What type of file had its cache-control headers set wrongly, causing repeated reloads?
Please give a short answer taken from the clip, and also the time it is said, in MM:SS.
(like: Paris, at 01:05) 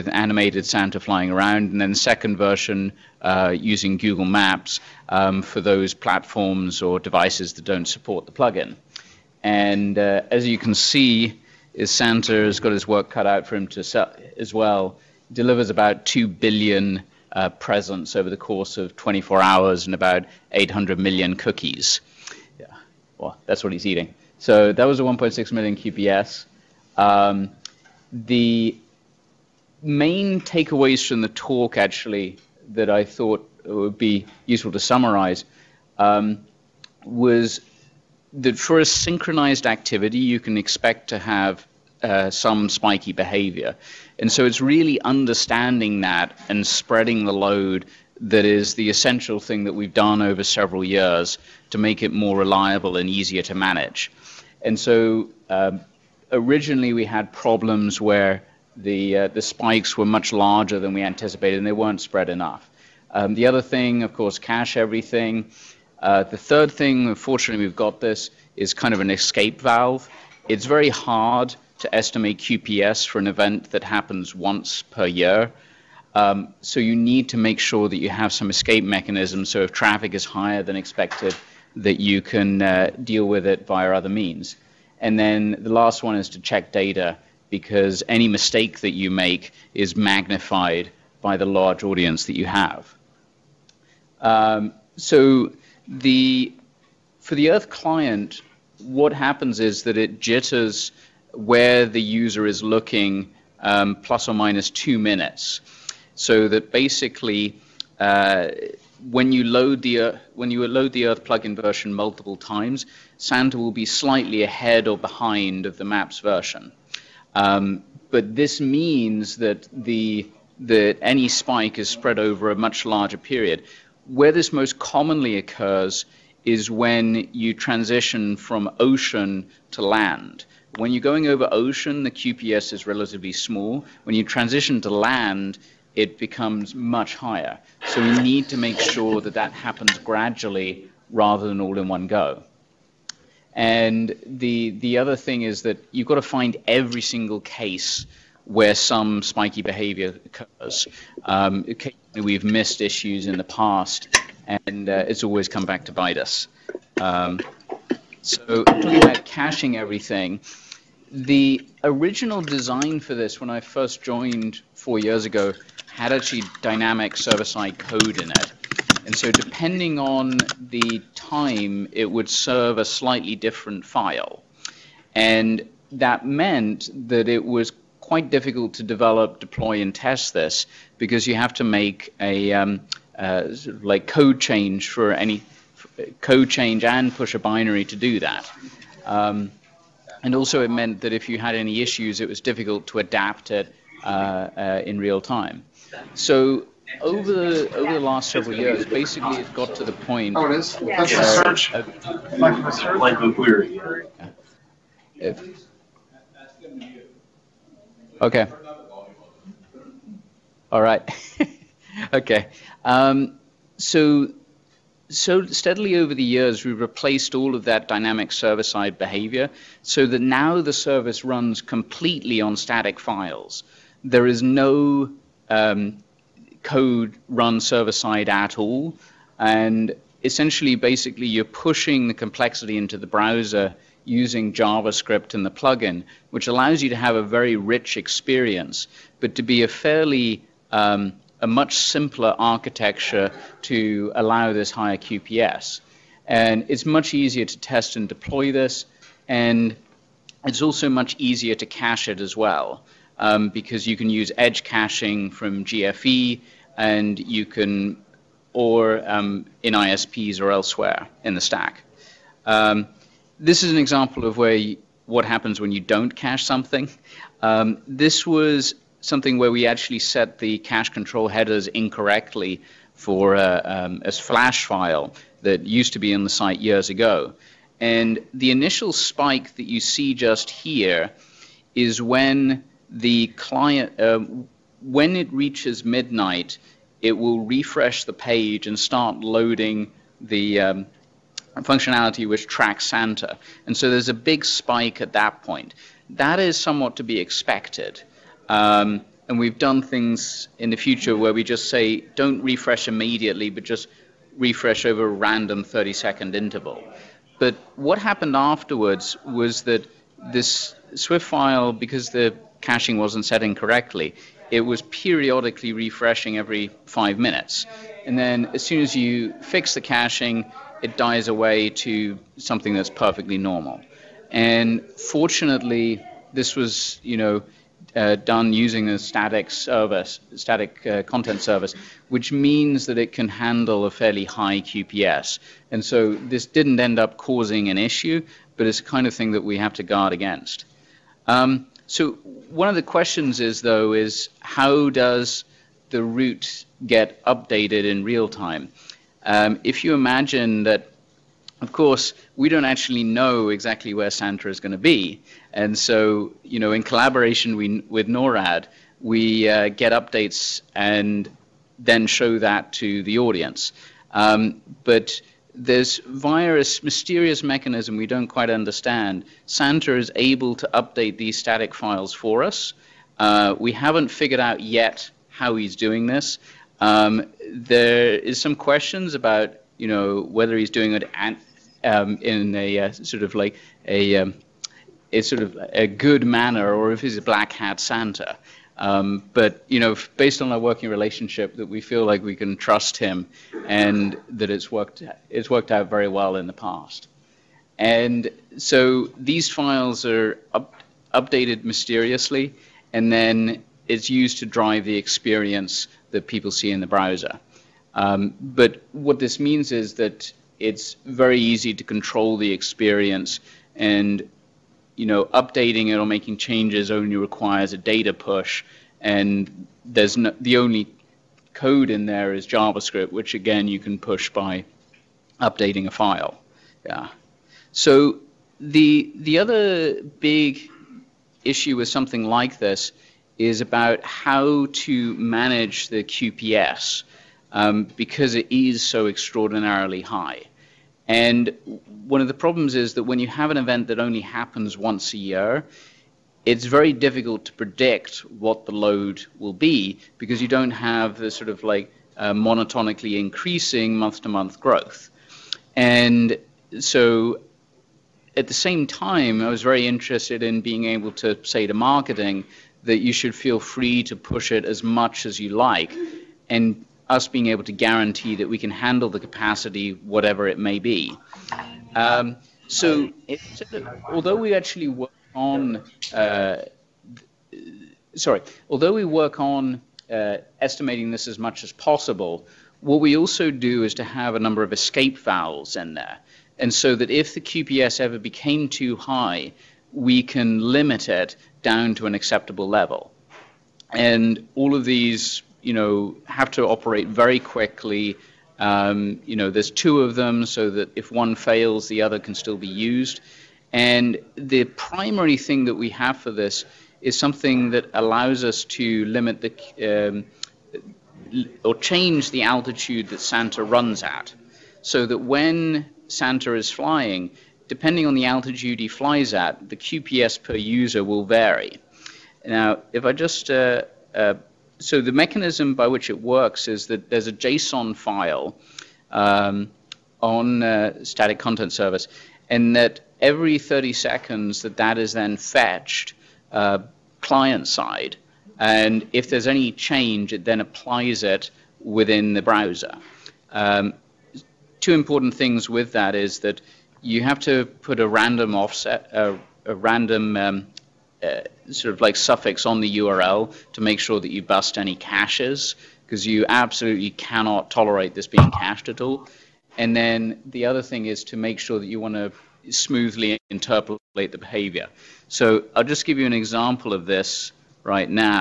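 flash file, at 04:34.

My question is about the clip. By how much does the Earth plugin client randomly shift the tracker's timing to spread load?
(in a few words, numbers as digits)
plus or minus 2 minutes.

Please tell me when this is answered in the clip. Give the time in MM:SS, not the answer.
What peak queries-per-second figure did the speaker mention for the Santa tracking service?
00:25.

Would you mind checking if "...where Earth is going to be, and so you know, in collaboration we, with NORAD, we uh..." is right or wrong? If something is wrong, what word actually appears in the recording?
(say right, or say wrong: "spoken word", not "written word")
wrong: "Santa", not "Earth".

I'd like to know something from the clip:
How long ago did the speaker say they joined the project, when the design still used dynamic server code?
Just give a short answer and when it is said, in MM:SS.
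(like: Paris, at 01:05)
4 years, at 02:44.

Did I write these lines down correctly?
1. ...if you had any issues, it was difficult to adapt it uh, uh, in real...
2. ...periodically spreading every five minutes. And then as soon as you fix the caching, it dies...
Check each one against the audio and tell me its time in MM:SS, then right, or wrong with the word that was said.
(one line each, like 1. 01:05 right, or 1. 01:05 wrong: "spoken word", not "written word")
1. 03:11 right
2. 05:14 wrong: "refreshing", not "spreading".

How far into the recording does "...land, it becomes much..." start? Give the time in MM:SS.
02:14.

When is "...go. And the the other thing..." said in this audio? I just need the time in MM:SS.
02:22.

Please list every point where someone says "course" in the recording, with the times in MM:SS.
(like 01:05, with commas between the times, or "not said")
00:18, 01:04, 05:51.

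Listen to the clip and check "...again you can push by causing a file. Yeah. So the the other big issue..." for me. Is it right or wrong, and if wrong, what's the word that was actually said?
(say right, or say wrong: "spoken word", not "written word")
wrong: "updating", not "causing".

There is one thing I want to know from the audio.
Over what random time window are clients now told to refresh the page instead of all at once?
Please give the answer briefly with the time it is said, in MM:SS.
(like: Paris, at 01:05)
30 seconds, at 05:05.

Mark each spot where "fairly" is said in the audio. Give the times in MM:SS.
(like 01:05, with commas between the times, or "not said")
03:59, 05:33.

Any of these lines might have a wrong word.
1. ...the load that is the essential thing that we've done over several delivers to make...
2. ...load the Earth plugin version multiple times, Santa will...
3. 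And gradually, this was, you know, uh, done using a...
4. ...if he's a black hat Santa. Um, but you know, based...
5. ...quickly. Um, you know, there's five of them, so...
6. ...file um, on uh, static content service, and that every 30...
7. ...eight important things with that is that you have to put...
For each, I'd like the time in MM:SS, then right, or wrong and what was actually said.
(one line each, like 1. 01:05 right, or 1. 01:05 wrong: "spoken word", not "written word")
1. 00:47 wrong: "years", not "delivers"
2. 01:50 right
3. 05:24 wrong: "fortunately", not "gradually"
4. 06:26 right
5. 08:17 wrong: "two", not "five"
6. 08:47 right
7. 09:04 wrong: "two", not "eight".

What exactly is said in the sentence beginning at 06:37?
And so these files are up, updated mysteriously, and then it's used to drive the experience that people see in the browser.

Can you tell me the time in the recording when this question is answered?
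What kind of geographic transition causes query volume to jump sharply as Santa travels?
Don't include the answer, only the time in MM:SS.
02:08.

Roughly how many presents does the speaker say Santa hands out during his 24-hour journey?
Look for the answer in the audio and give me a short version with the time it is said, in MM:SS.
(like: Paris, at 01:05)
2 billion, at 00:16.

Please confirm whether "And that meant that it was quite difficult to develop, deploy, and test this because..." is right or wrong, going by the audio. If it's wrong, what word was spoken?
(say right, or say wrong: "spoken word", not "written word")
right.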